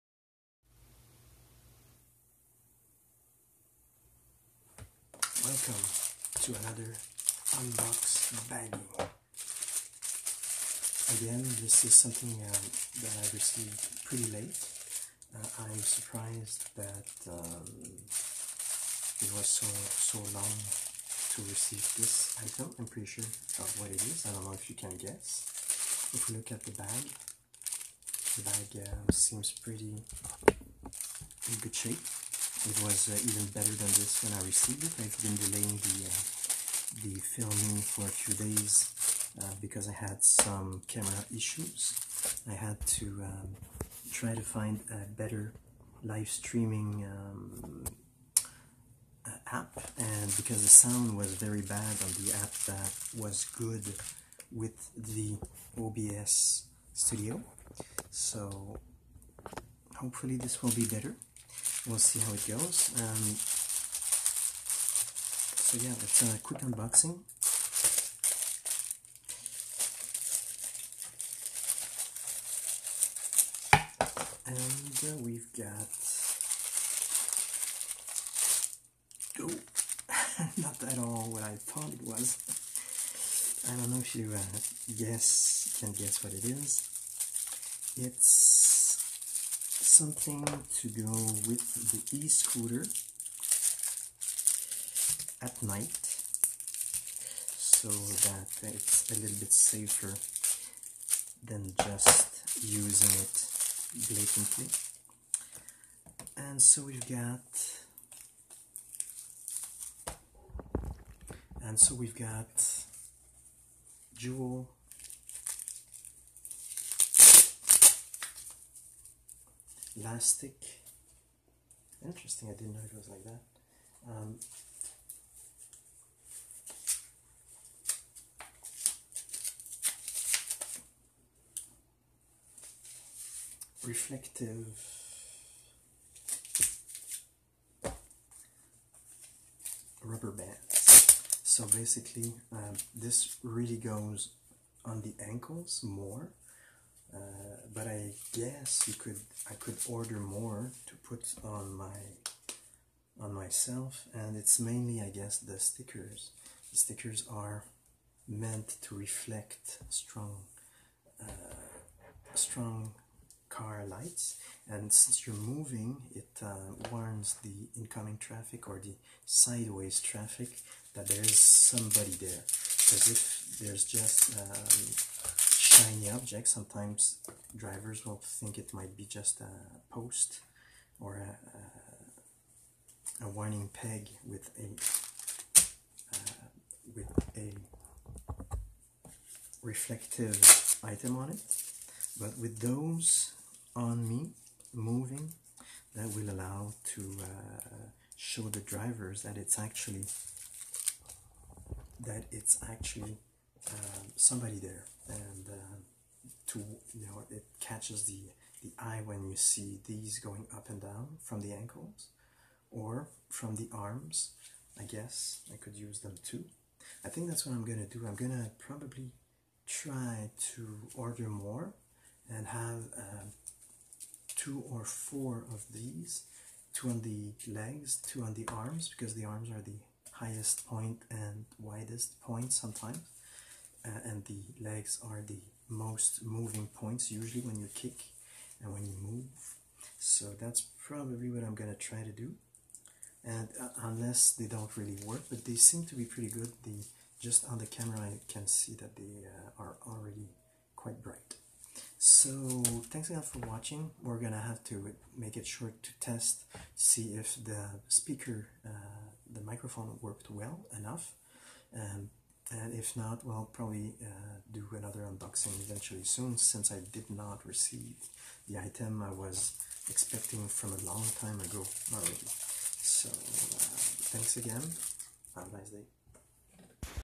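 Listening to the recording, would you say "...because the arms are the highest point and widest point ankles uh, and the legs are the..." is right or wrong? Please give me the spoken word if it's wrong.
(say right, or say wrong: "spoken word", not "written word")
wrong: "sometimes", not "ankles".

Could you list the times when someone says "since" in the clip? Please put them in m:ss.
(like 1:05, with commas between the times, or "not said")
2:44, 4:26.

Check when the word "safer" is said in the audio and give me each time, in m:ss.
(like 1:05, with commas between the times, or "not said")
1:39.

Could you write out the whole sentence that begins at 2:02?
Interesting, I didn't know it was like that.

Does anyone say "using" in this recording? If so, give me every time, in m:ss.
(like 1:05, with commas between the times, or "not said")
1:42.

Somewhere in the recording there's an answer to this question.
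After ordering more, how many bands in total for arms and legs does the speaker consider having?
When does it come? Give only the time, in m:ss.
3:44.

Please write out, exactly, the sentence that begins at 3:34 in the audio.
I guess I could use them too.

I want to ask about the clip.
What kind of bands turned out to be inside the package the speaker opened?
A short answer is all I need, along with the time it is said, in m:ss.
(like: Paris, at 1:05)
reflective rubber bands, at 2:13.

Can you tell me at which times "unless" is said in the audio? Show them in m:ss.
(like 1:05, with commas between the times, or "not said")
4:03.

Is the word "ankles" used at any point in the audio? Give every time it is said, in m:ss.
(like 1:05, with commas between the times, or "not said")
2:25, 3:31.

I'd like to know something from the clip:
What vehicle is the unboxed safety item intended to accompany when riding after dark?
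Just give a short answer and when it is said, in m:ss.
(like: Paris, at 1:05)
e-scooter, at 1:32.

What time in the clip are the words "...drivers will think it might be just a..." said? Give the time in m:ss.
2:57.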